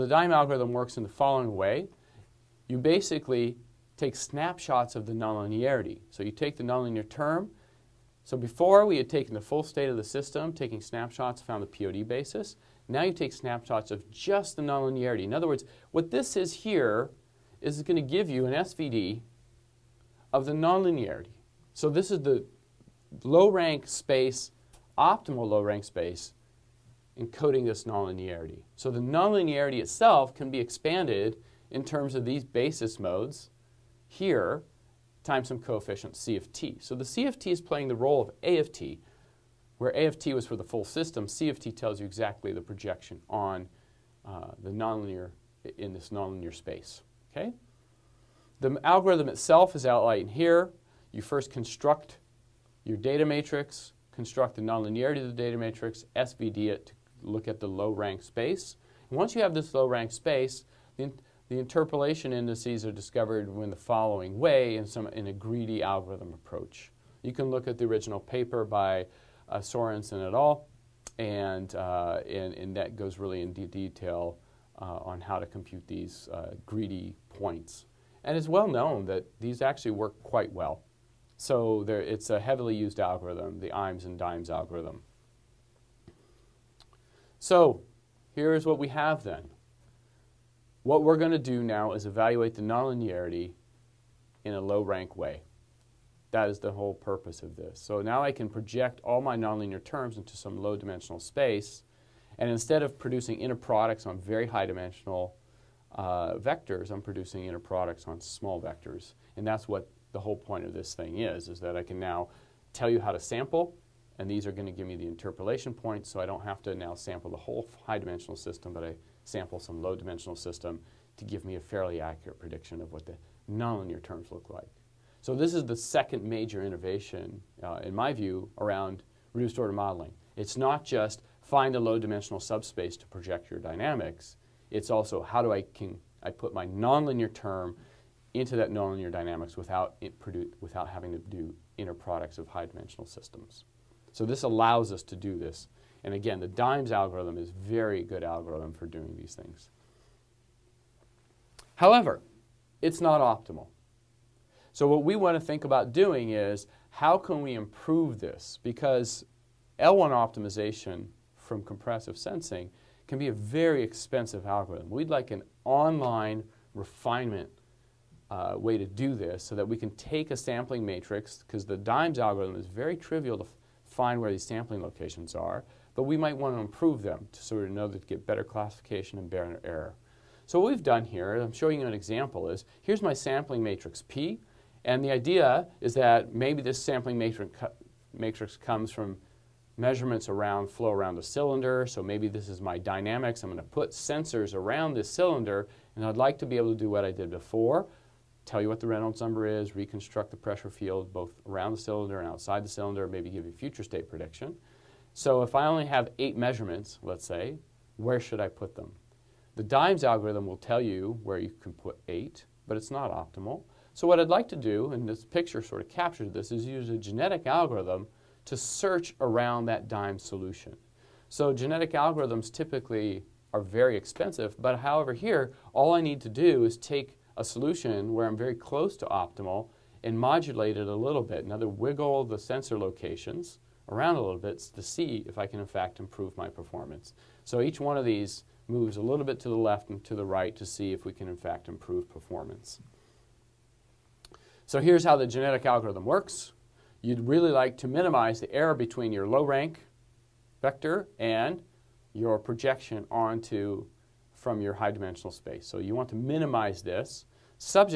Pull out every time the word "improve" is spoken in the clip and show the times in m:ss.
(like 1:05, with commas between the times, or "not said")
2:37, 2:56, 3:55, 4:01.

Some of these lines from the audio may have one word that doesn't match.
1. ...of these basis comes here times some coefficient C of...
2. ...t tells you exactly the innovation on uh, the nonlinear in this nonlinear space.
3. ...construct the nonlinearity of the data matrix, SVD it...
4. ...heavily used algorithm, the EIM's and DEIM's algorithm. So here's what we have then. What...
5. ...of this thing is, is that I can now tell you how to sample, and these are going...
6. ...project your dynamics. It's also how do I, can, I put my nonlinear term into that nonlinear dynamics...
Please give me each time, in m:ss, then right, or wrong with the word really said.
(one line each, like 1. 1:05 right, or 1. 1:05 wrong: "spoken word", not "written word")
1. 0:32 wrong: "modes", not "comes"
2. 0:41 wrong: "projection", not "innovation"
3. 0:54 right
4. 1:22 right
5. 1:50 right
6. 2:13 right.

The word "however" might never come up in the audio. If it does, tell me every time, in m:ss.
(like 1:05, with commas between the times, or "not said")
2:31, 3:44.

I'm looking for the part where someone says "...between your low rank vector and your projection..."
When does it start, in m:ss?
4:08.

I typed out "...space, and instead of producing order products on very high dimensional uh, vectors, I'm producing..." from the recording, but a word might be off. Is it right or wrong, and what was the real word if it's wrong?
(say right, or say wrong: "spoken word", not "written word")
wrong: "inner", not "order".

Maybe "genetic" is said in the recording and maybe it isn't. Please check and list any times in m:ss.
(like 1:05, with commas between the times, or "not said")
3:36, 3:41, 4:05.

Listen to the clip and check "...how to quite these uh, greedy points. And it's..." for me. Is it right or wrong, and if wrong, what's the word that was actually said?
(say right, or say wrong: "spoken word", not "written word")
wrong: "compute", not "quite".